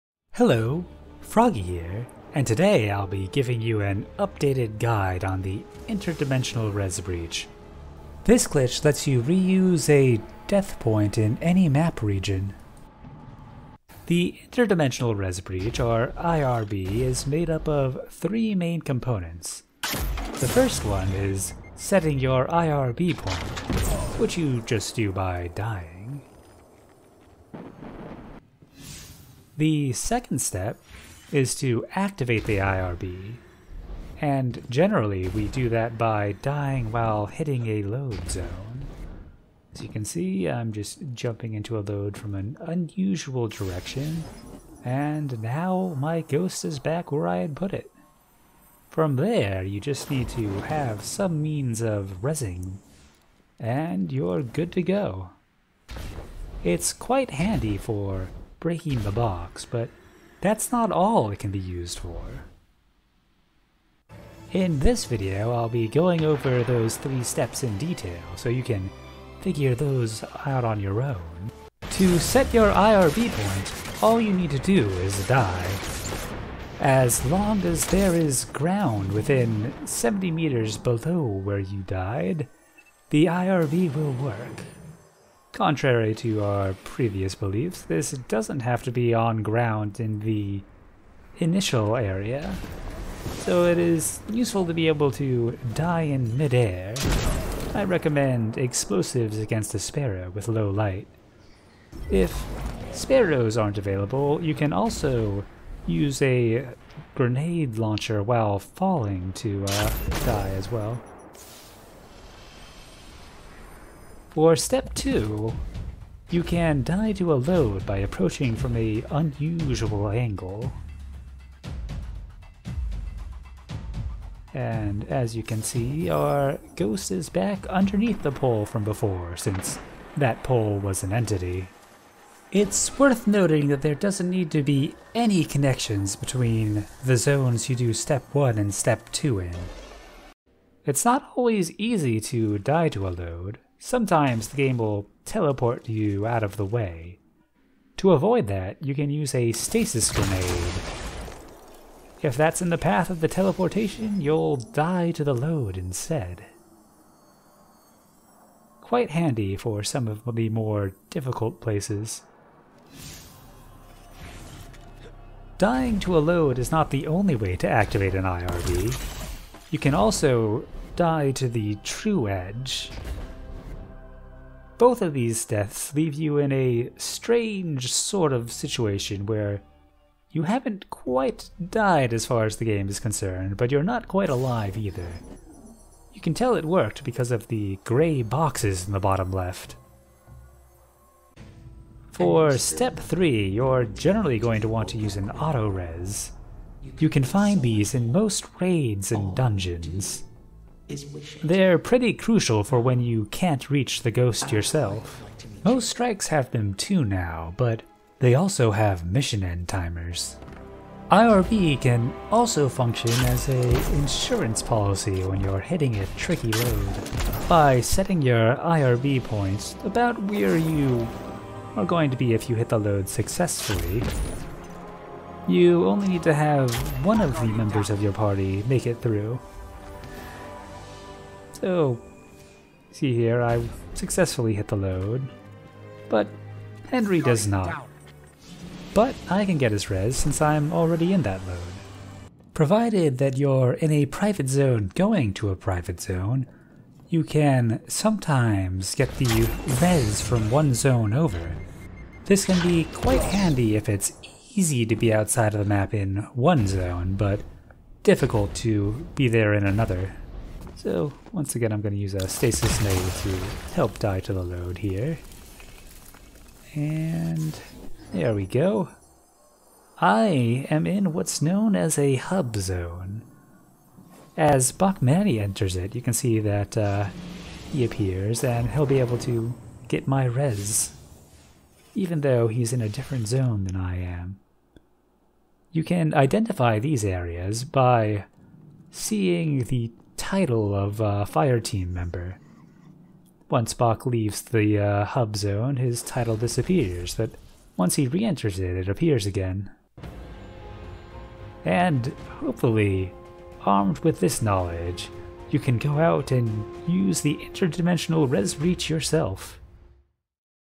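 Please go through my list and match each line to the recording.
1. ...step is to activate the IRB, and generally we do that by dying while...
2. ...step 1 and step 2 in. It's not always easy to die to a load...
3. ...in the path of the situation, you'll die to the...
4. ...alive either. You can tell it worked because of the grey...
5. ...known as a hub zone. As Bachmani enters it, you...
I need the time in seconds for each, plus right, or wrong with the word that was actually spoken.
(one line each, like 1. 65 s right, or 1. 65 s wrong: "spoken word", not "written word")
1. 30 s right
2. 137 s right
3. 152 s wrong: "teleportation", not "situation"
4. 184 s right
5. 271 s right.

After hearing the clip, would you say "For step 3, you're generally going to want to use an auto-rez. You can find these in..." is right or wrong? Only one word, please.
right.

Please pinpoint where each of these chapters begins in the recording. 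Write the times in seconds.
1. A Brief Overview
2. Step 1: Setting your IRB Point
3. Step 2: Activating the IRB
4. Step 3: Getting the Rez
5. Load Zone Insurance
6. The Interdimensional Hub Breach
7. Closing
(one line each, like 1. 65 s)
1. 13 s
2. 71 s
3. 115 s
4. 191 s
5. 210 s
6. 242 s
7. 300 s.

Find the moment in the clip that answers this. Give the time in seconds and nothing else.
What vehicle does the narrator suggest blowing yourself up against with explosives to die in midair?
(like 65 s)
98 s.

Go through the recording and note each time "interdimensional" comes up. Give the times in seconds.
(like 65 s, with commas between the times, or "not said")
5 s, 14 s, 307 s.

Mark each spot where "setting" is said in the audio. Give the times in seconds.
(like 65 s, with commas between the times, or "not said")
21 s, 217 s.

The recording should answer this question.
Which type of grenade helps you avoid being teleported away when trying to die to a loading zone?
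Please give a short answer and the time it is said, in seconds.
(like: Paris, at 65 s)
stasis grenade, at 149 s.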